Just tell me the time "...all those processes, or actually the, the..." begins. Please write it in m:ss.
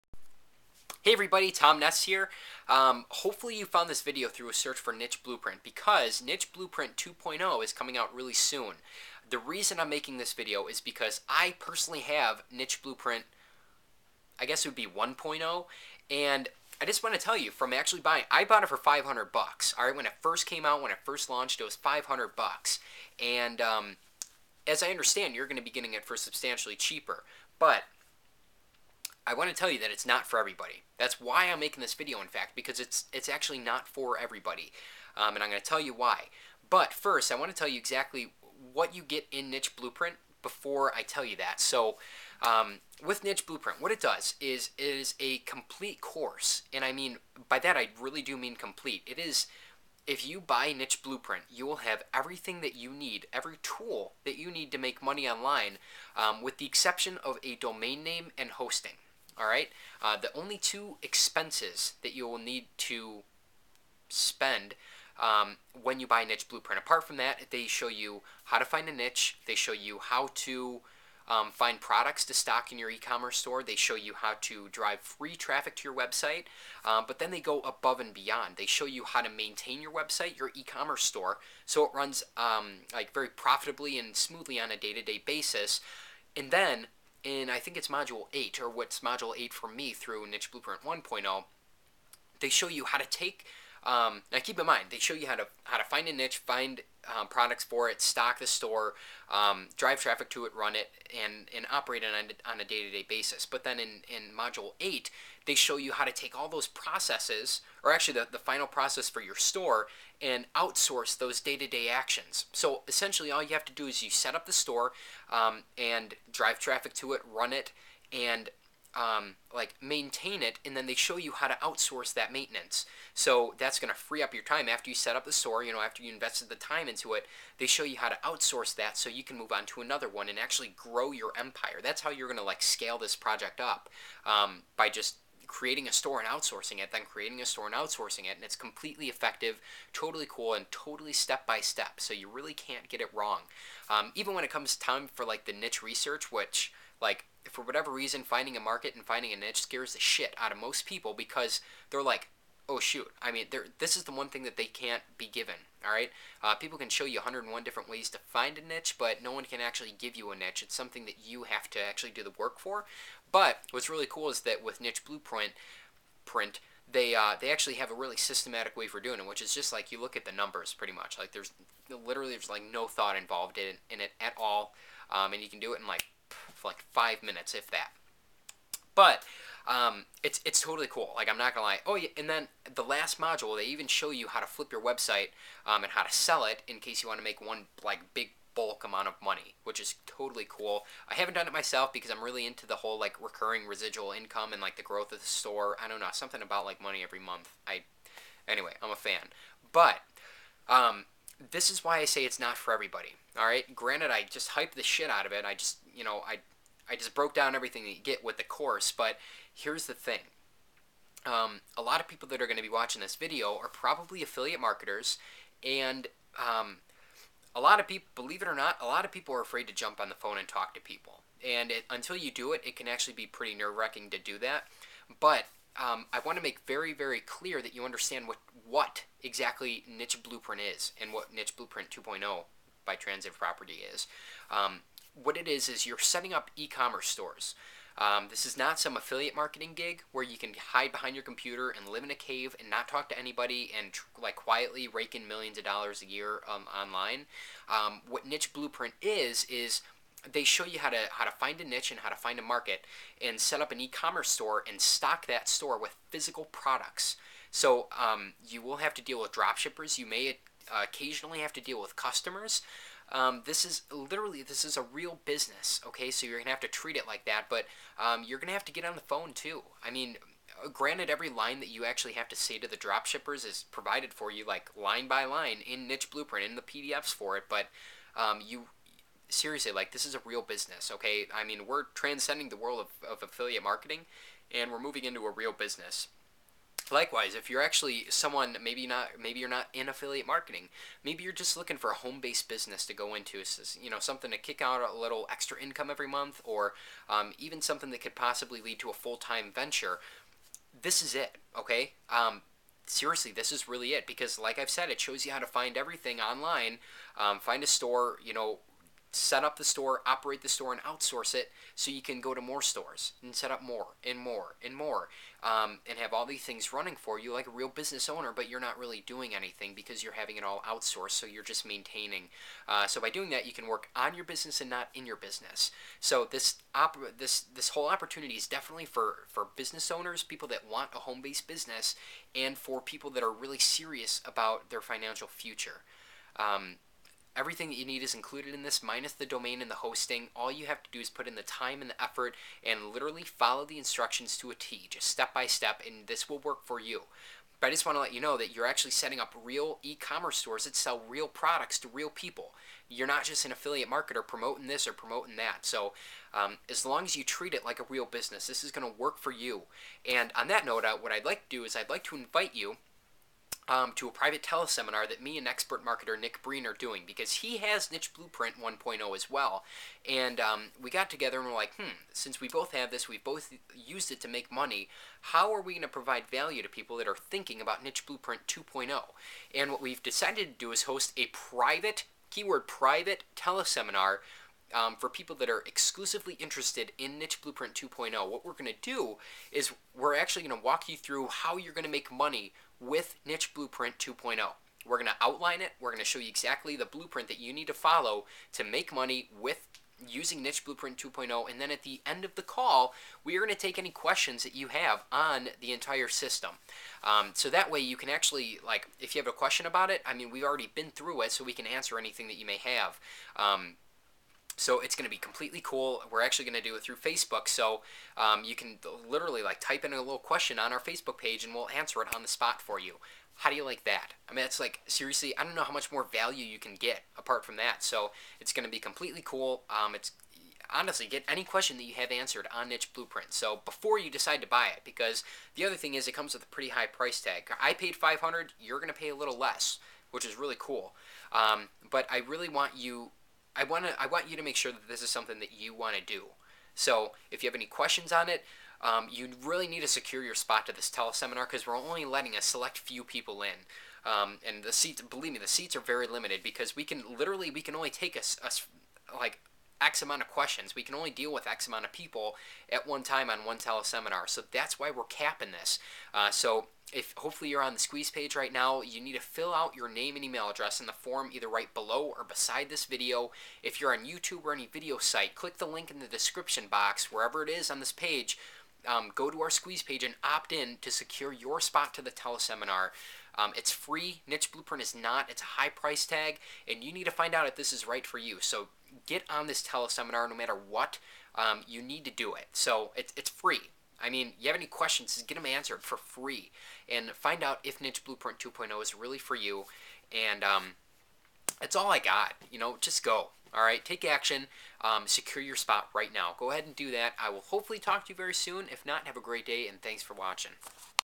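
1:46.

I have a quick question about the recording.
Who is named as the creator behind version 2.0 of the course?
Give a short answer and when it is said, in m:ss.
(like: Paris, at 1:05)
Transitive Property, at 3:52.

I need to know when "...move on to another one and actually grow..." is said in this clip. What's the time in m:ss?
2:09.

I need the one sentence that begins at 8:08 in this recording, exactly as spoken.
So get on this teleseminar no matter what.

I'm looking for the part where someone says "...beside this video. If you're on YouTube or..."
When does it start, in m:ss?
7:52.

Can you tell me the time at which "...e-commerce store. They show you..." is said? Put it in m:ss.
1:12.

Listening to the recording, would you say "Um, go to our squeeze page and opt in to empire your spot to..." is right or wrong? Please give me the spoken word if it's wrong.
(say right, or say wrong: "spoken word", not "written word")
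wrong: "secure", not "empire".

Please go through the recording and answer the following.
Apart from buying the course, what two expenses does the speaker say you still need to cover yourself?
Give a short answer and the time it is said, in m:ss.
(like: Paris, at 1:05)
Domain name and hosting, at 0:57.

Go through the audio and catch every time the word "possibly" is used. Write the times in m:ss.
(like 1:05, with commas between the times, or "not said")
4:58.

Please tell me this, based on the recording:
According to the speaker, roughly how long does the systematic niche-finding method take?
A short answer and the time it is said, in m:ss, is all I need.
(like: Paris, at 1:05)
5 minutes, at 2:56.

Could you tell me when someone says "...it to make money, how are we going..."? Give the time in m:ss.
6:14.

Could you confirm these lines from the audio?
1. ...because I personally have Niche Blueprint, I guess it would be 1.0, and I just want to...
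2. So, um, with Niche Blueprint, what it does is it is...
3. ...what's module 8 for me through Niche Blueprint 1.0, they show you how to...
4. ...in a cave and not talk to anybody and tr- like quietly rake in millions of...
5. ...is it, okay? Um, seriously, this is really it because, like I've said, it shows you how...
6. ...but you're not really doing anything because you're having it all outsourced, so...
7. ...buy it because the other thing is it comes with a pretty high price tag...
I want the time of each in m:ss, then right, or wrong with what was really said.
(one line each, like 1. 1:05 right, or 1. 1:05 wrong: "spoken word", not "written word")
1. 0:10 right
2. 0:41 right
3. 1:28 right
4. 4:02 right
5. 5:01 right
6. 5:18 right
7. 7:14 right.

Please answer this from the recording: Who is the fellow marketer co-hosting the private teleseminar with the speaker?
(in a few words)
Nick Breen.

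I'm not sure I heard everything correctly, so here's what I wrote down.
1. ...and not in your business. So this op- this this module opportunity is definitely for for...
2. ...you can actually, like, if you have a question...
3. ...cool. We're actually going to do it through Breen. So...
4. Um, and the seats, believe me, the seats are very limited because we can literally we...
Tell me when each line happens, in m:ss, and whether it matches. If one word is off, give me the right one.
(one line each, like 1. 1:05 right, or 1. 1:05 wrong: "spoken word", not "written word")
1. 5:24 wrong: "whole", not "module"
2. 6:47 right
3. 6:55 wrong: "Facebook", not "Breen"
4. 7:34 right.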